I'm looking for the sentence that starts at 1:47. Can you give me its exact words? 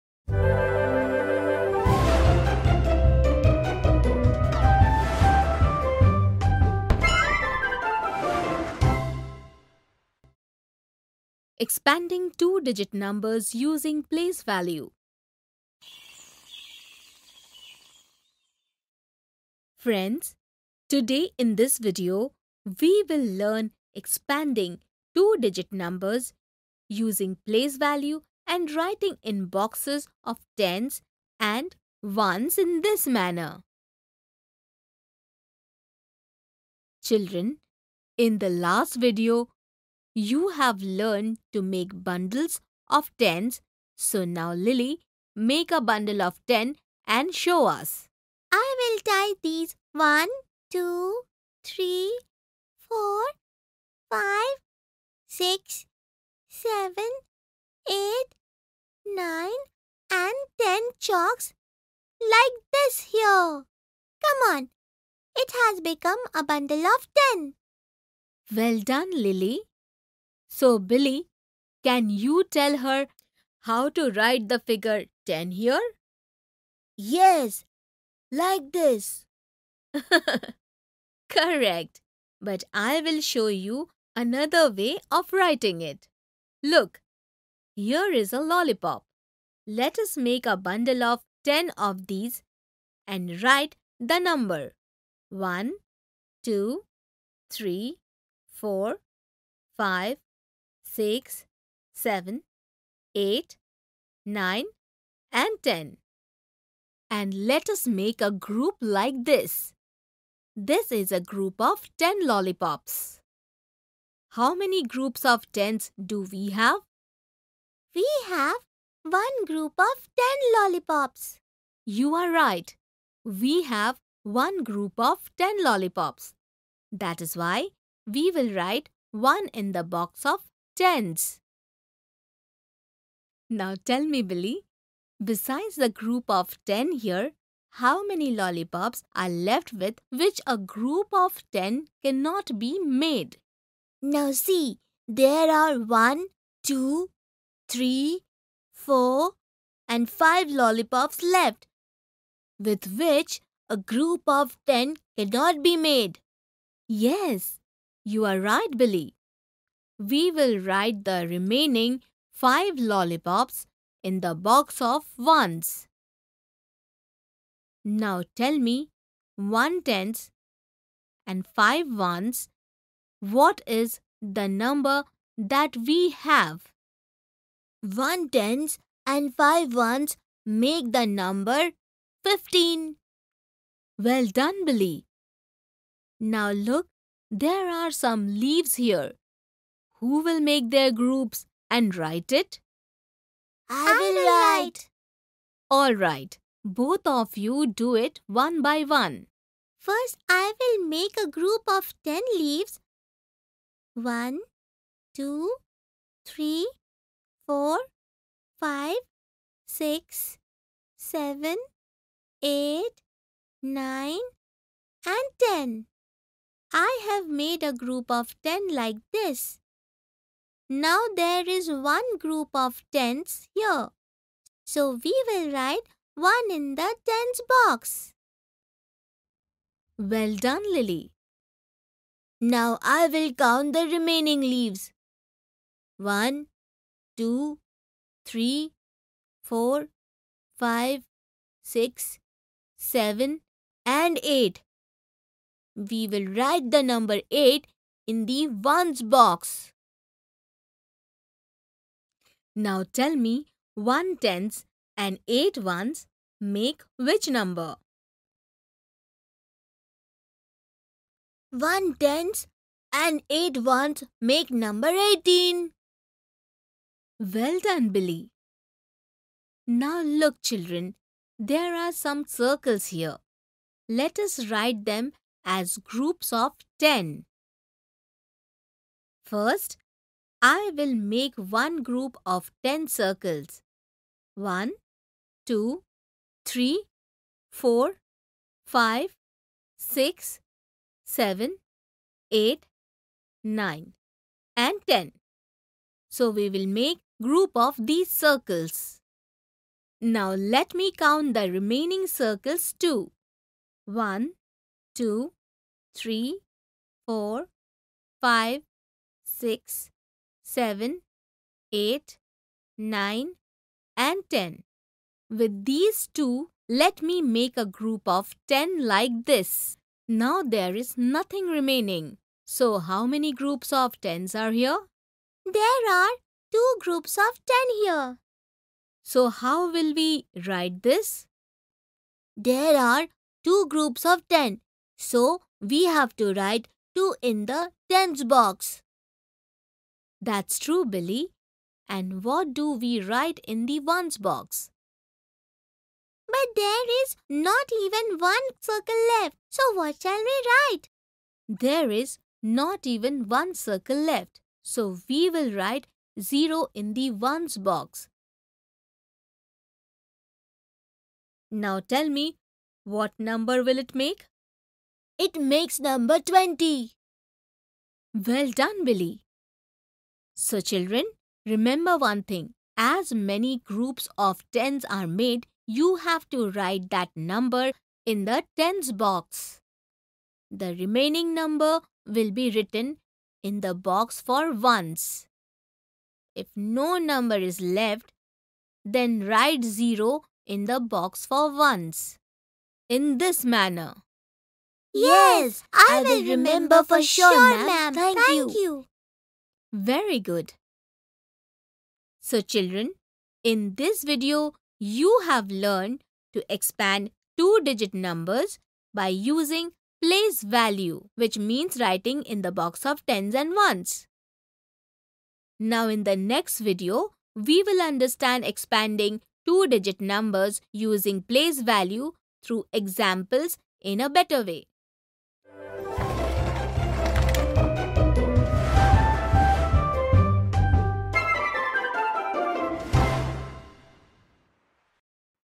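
And let us make a group like this.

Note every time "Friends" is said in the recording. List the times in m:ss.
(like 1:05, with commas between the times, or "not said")
0:19.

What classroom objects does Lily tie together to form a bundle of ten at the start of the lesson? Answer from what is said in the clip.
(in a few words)
chalks.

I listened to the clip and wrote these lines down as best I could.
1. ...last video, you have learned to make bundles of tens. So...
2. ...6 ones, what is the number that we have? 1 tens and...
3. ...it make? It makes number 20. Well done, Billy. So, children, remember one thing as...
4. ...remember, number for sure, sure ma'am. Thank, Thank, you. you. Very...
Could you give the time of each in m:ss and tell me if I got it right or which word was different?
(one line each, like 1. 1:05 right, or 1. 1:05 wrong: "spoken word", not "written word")
1. 0:38 right
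2. 2:51 wrong: "5", not "6"
3. 6:03 right
4. 6:36 wrong: "remember", not "number".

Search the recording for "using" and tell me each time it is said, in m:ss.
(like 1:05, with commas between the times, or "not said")
0:13, 0:26, 6:49, 7:00.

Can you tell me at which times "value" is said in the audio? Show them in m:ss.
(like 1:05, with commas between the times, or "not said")
0:14, 0:27, 6:50, 7:01.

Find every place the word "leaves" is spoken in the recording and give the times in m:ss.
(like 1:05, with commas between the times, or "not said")
3:08, 3:22, 3:54.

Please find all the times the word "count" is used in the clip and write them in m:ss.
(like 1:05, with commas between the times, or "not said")
3:53, 5:00.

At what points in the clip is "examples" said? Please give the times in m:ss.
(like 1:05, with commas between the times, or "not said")
7:02.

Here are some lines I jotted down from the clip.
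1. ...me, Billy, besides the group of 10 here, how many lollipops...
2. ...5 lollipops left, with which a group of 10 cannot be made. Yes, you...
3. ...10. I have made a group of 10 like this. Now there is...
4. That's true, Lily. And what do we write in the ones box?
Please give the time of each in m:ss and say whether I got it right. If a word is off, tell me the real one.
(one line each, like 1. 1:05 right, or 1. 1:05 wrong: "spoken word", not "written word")
1. 2:14 right
2. 2:30 right
3. 3:35 right
4. 5:40 wrong: "Billy", not "Lily".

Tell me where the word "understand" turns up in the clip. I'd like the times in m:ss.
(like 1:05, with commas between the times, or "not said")
6:57.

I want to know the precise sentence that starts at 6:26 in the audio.
If no number is left, then write 0 in the box for ones.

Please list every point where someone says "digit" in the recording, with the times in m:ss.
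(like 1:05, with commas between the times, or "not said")
0:12, 0:25, 6:47, 6:59.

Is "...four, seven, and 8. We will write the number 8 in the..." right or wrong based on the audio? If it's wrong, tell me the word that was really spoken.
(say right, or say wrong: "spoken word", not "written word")
wrong: "six", not "four".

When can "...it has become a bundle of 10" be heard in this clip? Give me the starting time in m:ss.
1:05.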